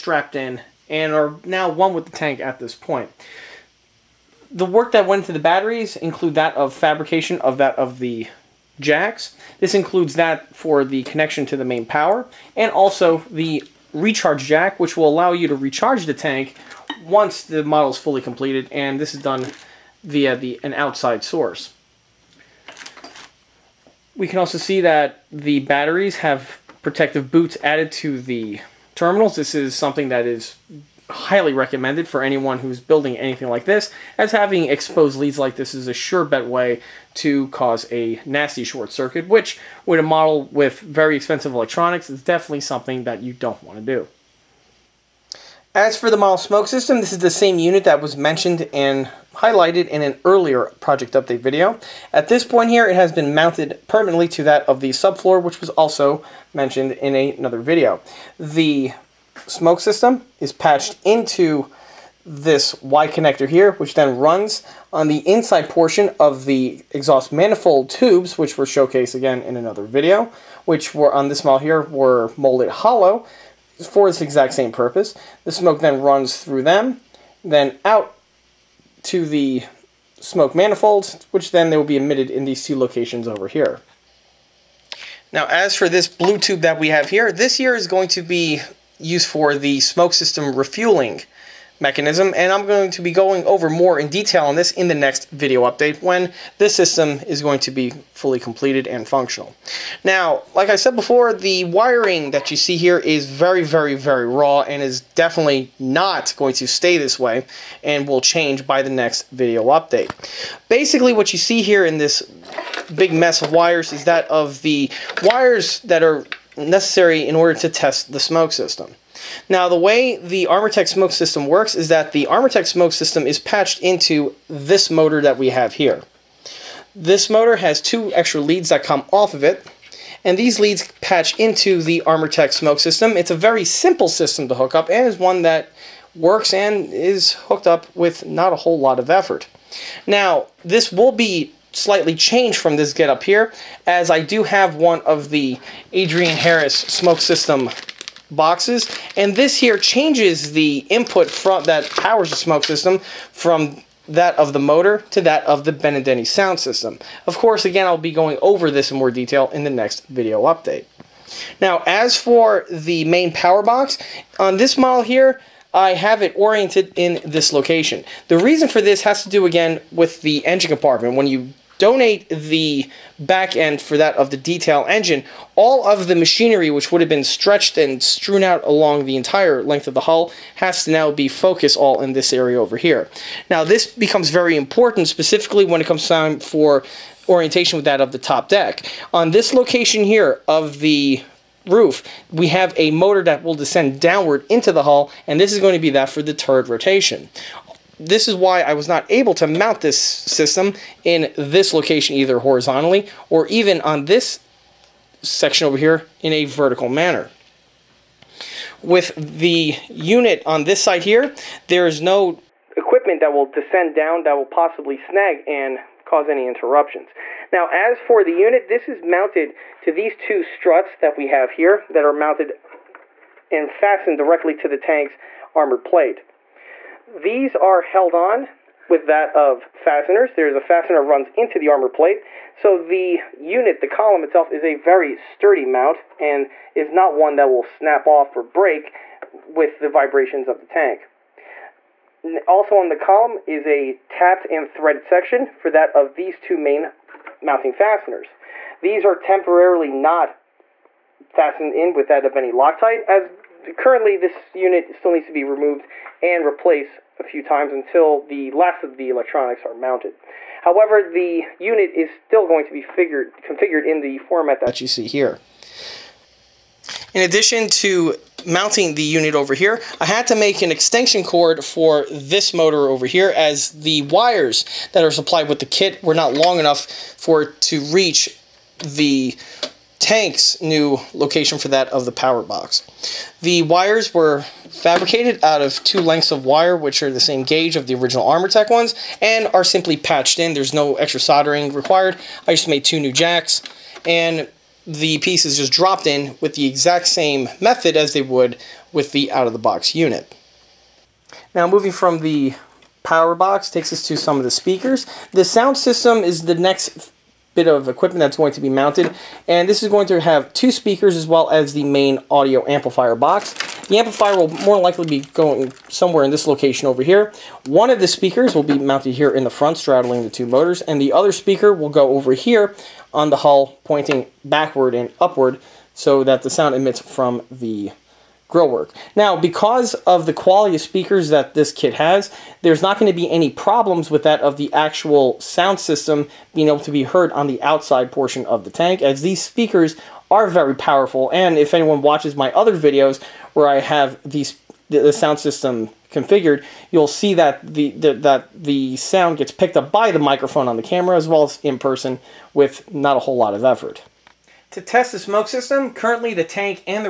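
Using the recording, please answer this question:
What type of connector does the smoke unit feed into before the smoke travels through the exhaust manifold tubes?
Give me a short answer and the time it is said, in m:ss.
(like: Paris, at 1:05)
Y connector, at 1:02.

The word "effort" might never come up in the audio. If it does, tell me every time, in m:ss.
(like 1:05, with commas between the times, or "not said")
2:19, 5:53.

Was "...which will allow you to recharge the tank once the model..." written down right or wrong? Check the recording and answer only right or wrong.
right.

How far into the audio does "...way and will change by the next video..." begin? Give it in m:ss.
1:47.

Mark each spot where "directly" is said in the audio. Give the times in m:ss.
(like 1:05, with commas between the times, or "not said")
3:44.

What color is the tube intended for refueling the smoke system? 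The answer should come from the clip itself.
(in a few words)
Blue.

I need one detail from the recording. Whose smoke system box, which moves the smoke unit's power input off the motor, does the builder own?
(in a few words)
Adrian Harris.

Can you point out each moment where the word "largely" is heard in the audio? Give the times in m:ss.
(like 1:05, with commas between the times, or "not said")
not said.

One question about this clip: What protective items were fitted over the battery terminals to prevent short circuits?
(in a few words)
Protective boots.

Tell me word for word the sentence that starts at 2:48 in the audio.
The reason for this has to do, again, with the engine compartment.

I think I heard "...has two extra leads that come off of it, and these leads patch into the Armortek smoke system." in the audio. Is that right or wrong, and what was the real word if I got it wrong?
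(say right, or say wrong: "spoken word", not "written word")
right.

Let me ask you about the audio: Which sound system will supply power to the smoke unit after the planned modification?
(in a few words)
Benedini.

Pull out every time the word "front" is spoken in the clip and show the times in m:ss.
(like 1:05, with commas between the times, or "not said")
2:31, 5:19.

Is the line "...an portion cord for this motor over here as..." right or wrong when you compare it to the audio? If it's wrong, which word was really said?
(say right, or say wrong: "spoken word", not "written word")
wrong: "extension", not "portion".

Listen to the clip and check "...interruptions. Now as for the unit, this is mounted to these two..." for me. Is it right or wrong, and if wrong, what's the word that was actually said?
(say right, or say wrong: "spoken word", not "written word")
right.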